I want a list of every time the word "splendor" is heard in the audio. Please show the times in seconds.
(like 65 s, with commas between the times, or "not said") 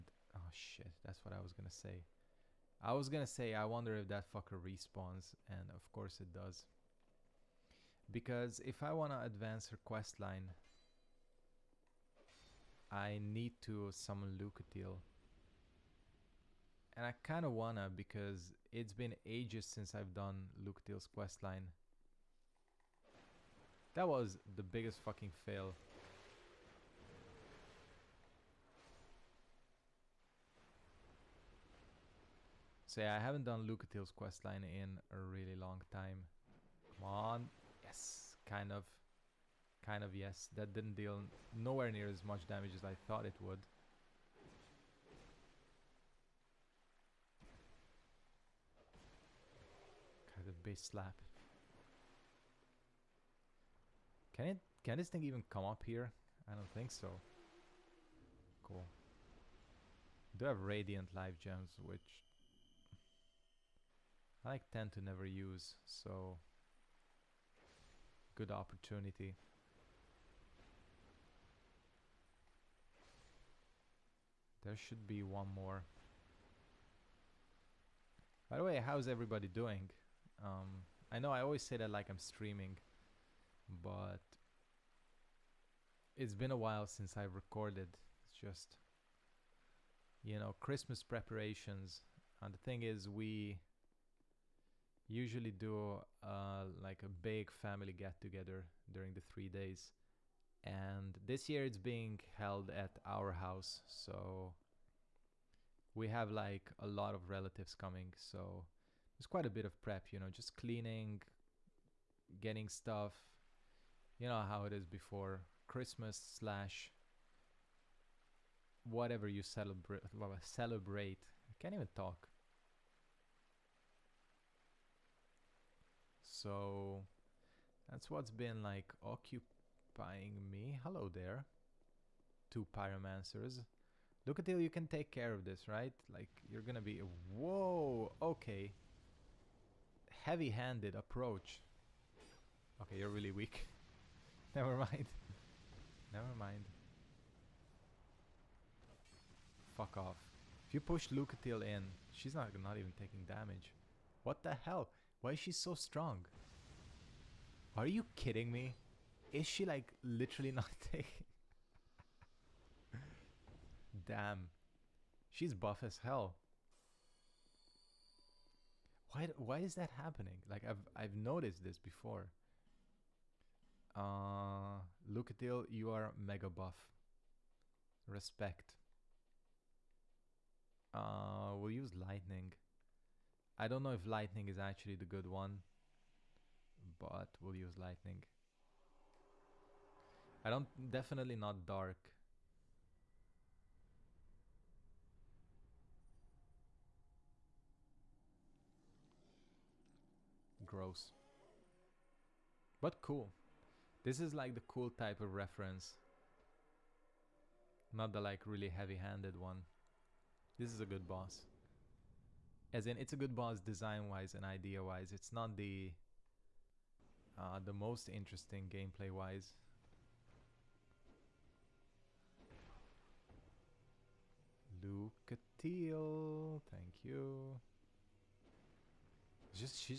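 not said.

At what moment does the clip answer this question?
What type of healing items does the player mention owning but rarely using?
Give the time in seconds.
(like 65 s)
60 s.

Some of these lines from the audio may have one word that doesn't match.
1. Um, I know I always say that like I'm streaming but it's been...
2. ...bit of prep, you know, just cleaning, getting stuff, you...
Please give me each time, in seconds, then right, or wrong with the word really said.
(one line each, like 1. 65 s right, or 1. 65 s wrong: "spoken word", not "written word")
1. 80 s right
2. 109 s right.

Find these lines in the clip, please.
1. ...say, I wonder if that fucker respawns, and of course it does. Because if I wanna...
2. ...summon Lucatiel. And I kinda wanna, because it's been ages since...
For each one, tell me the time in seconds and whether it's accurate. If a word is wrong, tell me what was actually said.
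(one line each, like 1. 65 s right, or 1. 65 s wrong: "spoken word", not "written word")
1. 3 s right
2. 13 s right.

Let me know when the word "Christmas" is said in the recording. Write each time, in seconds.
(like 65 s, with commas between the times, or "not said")
90 s, 115 s.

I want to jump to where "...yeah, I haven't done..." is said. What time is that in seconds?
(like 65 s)
32 s.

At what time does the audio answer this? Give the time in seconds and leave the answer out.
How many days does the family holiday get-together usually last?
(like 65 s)
99 s.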